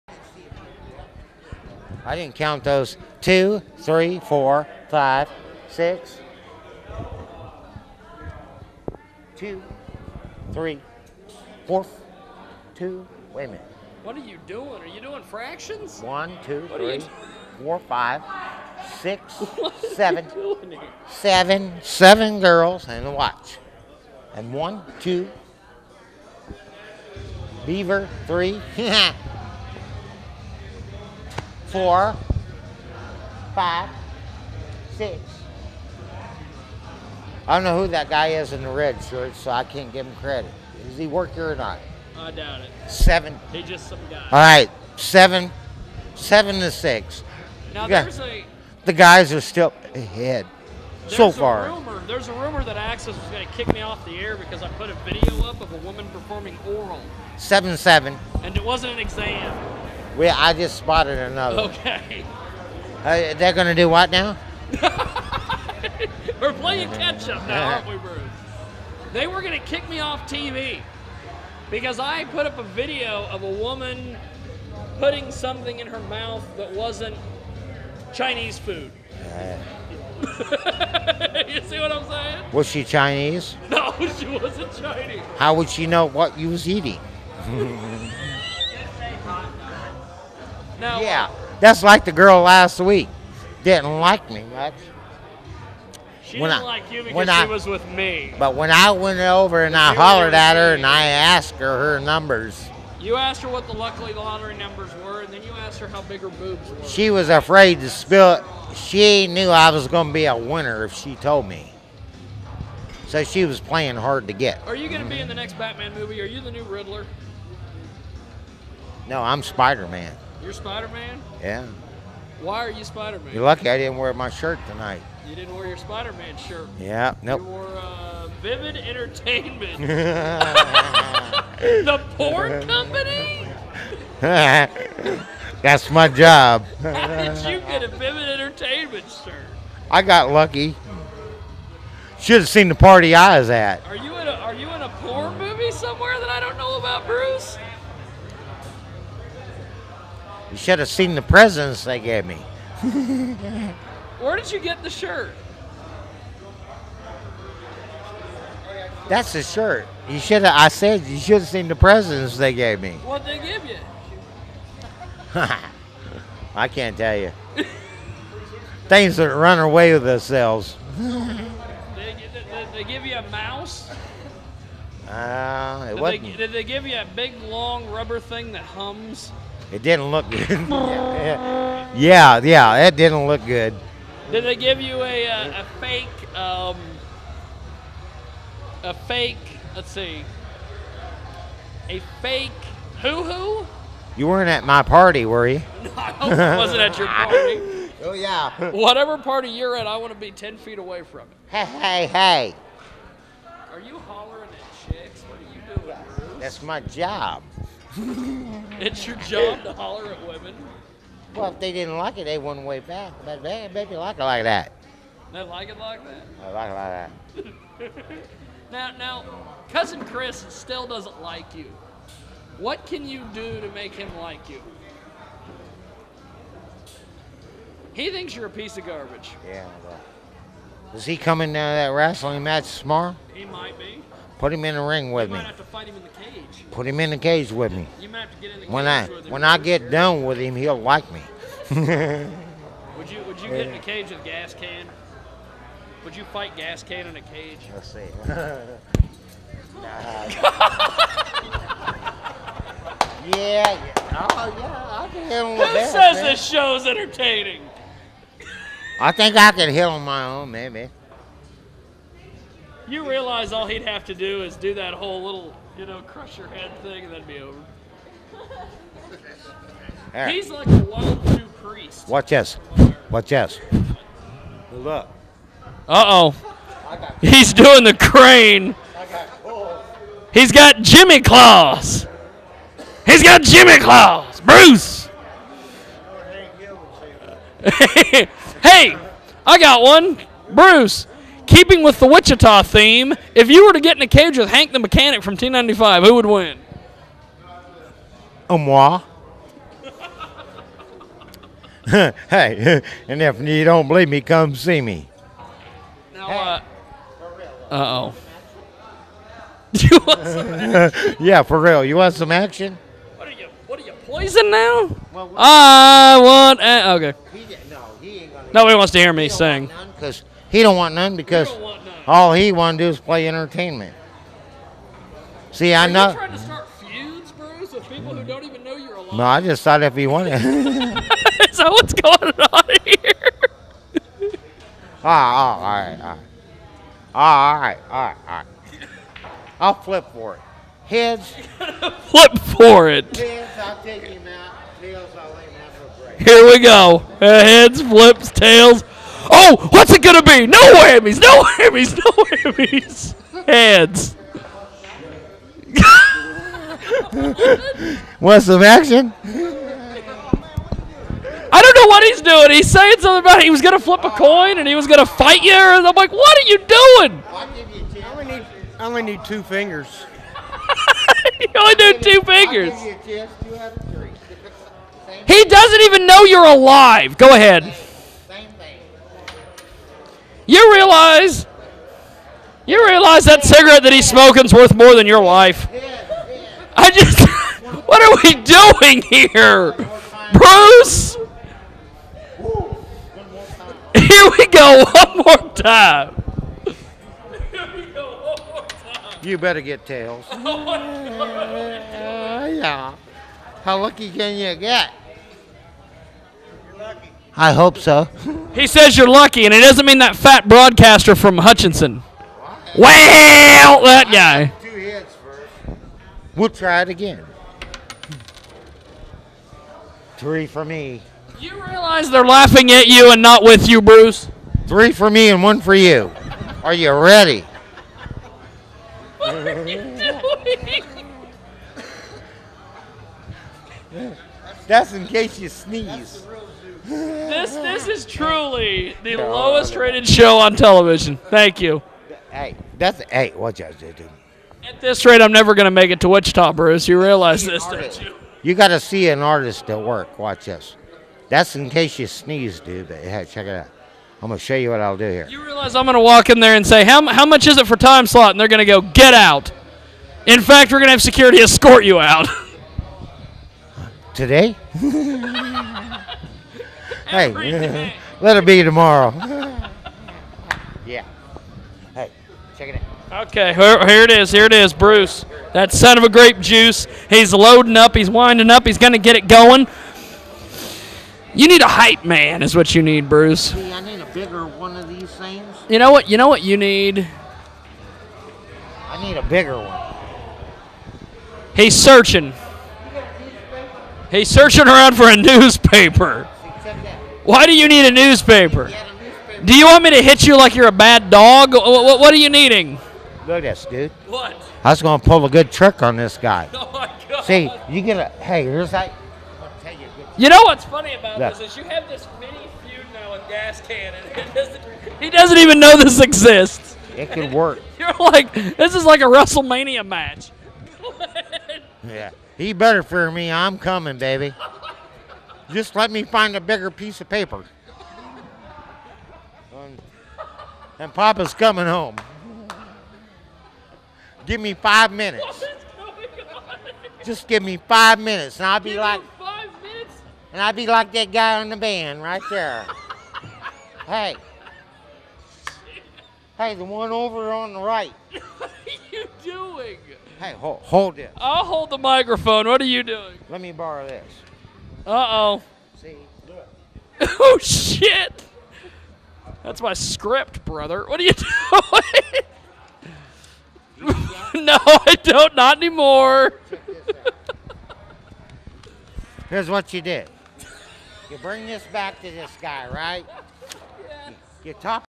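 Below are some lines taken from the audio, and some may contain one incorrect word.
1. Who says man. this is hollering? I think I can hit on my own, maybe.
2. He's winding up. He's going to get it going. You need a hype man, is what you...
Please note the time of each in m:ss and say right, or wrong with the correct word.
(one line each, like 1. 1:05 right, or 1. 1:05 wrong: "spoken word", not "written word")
1. 4:15 wrong: "entertaining", not "hollering"
2. 7:57 right.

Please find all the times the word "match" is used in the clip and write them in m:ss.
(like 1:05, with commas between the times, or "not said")
3:52, 8:39.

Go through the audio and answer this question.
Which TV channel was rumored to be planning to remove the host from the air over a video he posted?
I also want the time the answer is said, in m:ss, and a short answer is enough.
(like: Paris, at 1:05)
Access, at 0:52.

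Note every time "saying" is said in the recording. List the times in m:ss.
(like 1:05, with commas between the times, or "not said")
1:22, 6:02.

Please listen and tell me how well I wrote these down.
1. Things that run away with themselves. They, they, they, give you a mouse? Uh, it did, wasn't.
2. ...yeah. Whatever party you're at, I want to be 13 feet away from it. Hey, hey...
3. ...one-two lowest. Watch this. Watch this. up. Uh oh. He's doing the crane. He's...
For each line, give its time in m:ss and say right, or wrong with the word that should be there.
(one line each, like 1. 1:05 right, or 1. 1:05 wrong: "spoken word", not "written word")
1. 2:48 right
2. 3:18 wrong: "10", not "13"
3. 4:30 wrong: "priest", not "lowest".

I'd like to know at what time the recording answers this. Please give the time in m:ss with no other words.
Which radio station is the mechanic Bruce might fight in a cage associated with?
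4:55.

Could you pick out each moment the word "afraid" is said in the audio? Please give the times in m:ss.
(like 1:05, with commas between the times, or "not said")
1:47.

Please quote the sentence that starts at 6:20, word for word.
You realize, you realize that cigarette that he's smoking's worth more than your life.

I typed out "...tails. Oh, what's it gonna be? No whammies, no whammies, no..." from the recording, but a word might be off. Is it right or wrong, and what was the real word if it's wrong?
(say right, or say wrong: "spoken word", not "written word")
right.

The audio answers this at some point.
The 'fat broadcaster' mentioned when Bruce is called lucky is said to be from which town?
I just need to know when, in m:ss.
6:51.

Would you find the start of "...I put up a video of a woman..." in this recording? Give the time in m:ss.
1:11.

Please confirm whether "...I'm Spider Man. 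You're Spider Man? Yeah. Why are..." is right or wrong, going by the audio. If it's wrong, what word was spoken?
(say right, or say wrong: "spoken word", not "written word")
right.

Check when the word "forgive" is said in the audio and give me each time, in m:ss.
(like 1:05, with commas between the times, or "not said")
not said.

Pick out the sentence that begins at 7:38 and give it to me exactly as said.
And they're going to go, get out.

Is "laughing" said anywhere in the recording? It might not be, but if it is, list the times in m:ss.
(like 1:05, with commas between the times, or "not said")
7:02.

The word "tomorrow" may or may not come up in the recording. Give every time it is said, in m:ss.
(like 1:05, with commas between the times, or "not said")
3:52, 7:48.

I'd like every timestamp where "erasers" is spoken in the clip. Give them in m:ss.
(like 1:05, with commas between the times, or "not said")
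not said.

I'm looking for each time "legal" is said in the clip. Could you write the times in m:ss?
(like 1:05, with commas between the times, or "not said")
not said.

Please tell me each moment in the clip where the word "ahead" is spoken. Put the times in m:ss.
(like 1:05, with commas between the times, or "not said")
0:49, 6:17.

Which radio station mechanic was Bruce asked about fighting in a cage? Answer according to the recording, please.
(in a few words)
Hank the Mechanic.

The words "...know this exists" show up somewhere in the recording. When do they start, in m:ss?
8:35.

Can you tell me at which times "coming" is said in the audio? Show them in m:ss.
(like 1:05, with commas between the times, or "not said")
3:51, 8:43, 8:51.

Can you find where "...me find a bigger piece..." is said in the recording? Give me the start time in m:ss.
8:45.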